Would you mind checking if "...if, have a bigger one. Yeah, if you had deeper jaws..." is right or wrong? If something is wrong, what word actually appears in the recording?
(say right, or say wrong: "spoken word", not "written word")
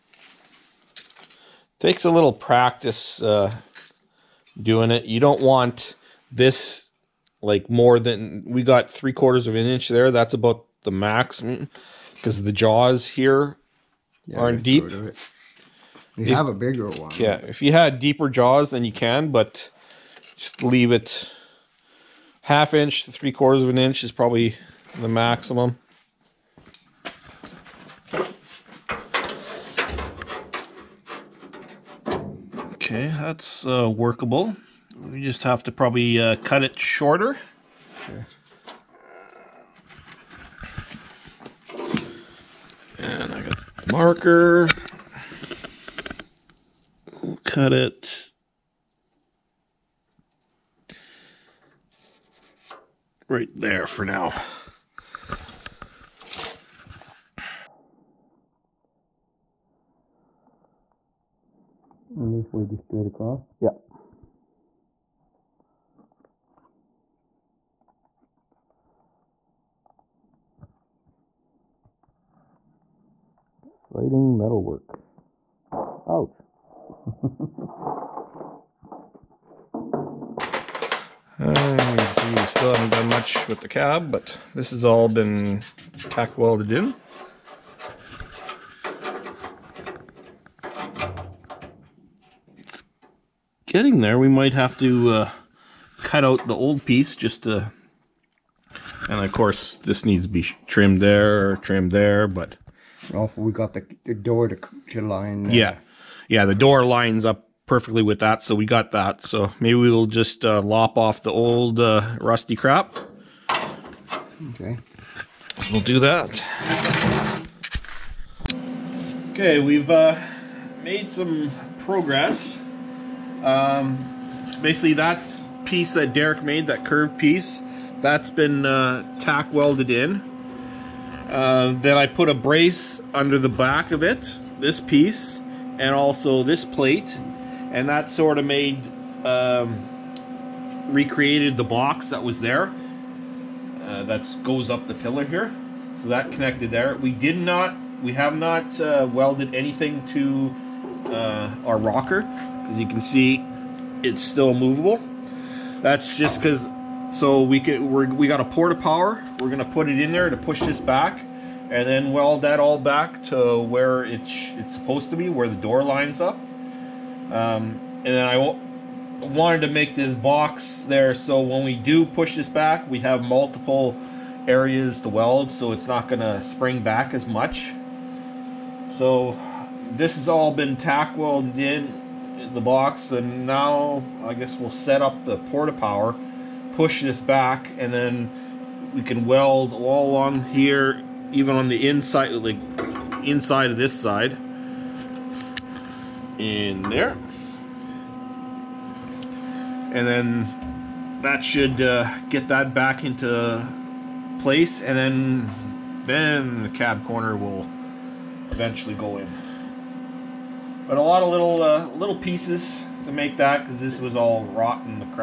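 right.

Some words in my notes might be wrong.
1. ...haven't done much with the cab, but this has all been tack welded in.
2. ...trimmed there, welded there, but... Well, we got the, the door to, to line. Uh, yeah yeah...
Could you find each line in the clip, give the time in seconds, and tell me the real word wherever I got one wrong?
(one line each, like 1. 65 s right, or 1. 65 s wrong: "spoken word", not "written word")
1. 82 s right
2. 100 s wrong: "trimmed", not "welded".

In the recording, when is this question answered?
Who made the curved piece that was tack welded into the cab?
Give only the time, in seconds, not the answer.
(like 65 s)
126 s.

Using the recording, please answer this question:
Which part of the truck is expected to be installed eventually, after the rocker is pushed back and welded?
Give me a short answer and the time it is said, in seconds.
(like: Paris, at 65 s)
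Cab corner, at 206 s.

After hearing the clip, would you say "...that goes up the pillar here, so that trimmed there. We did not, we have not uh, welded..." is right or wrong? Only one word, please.
wrong.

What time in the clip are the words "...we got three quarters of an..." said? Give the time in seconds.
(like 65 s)
8 s.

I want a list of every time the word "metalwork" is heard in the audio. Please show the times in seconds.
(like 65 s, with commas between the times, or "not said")
74 s.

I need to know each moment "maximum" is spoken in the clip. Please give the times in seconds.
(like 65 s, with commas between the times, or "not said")
10 s, 25 s.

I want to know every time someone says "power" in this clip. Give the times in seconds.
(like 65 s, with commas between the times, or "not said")
158 s, 185 s.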